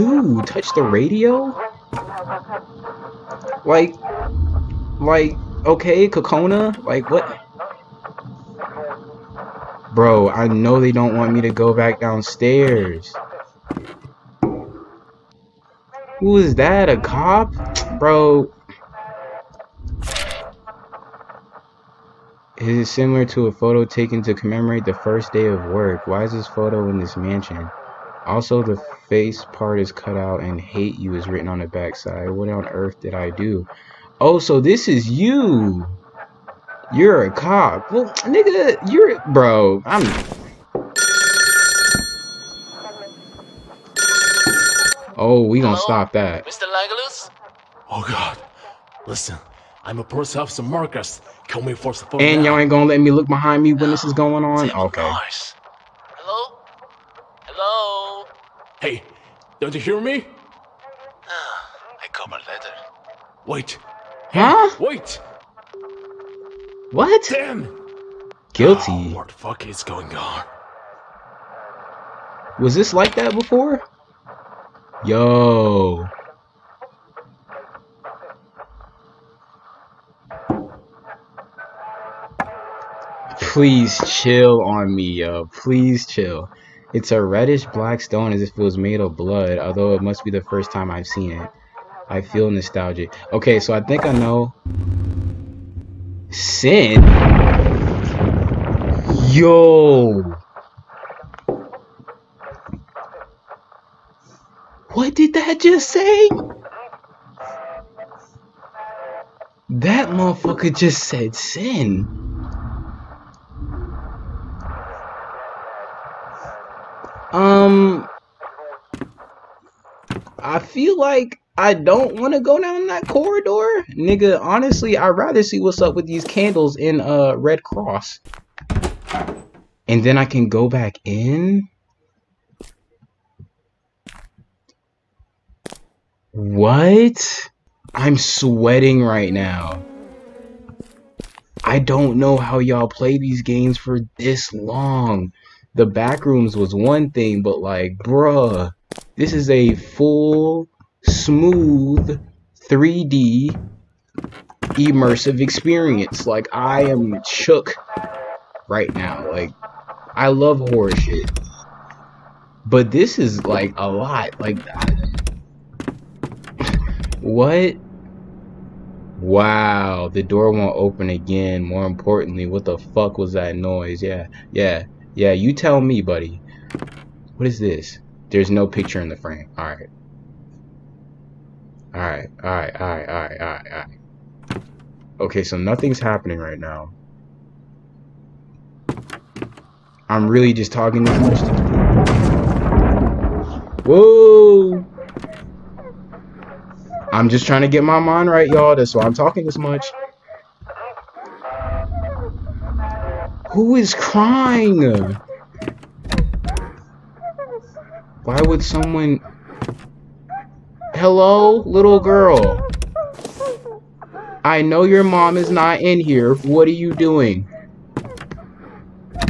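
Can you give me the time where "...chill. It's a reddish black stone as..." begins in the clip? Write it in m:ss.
1:26.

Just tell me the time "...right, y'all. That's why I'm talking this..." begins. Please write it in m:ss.
3:18.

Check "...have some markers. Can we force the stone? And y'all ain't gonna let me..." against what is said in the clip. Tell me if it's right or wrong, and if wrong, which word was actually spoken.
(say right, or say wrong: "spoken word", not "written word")
wrong: "phone", not "stone".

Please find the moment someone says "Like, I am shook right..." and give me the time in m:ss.
2:36.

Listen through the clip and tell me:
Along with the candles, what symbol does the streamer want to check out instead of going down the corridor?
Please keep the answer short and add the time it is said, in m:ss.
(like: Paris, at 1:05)
Red Cross, at 2:07.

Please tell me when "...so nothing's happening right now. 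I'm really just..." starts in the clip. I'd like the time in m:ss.
3:05.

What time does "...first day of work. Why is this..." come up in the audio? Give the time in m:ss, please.
0:24.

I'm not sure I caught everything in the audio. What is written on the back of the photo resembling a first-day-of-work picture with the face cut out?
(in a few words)
hate you.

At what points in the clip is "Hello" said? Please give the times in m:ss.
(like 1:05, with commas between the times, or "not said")
0:45, 3:30.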